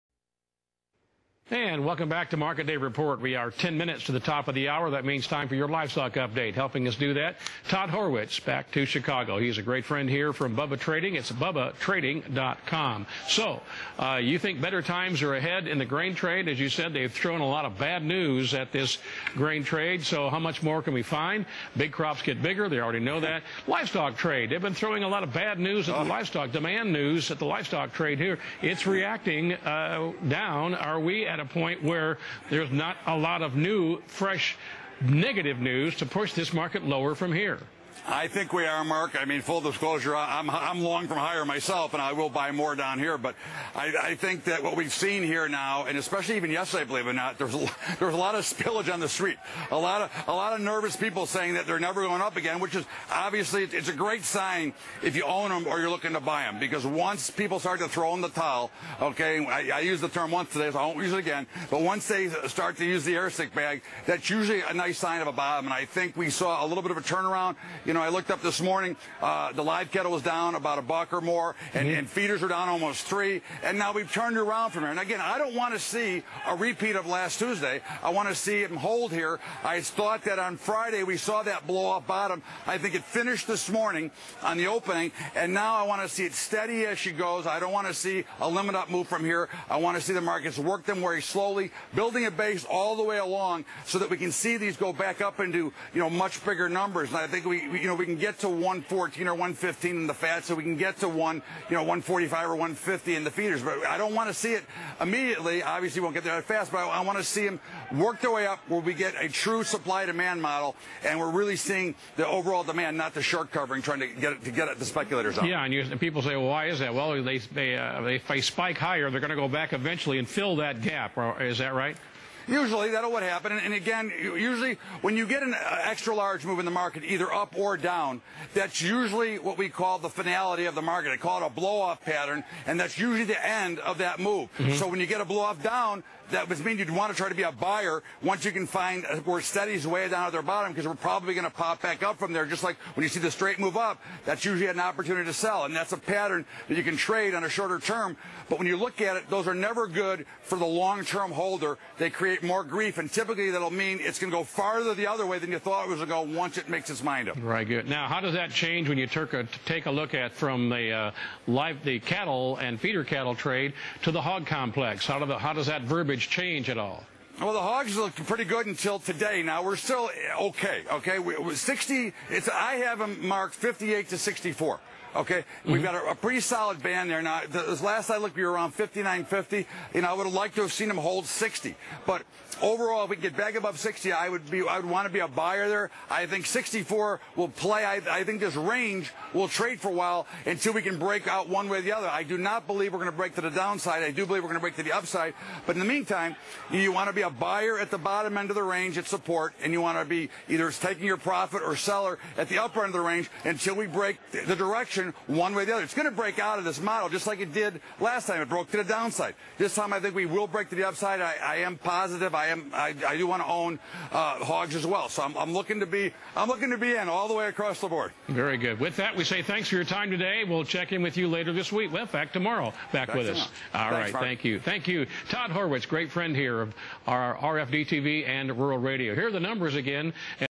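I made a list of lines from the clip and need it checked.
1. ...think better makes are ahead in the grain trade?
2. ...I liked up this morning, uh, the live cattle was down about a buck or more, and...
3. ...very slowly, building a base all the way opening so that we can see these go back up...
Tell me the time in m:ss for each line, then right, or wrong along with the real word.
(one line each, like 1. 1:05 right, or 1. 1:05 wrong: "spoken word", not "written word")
1. 0:14 wrong: "times", not "makes"
2. 1:08 wrong: "looked", not "liked"
3. 1:31 wrong: "along", not "opening".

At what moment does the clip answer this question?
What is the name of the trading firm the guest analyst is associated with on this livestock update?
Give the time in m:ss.
0:10.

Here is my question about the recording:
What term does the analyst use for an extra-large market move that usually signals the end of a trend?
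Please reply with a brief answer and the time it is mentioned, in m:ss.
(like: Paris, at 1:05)
blow off pattern, at 2:11.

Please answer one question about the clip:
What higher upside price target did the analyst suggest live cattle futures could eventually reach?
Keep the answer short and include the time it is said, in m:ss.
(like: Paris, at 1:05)
115, at 1:39.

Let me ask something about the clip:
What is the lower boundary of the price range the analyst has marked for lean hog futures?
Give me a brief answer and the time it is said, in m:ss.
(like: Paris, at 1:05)
58, at 2:53.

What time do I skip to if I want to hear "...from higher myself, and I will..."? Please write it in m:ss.
0:41.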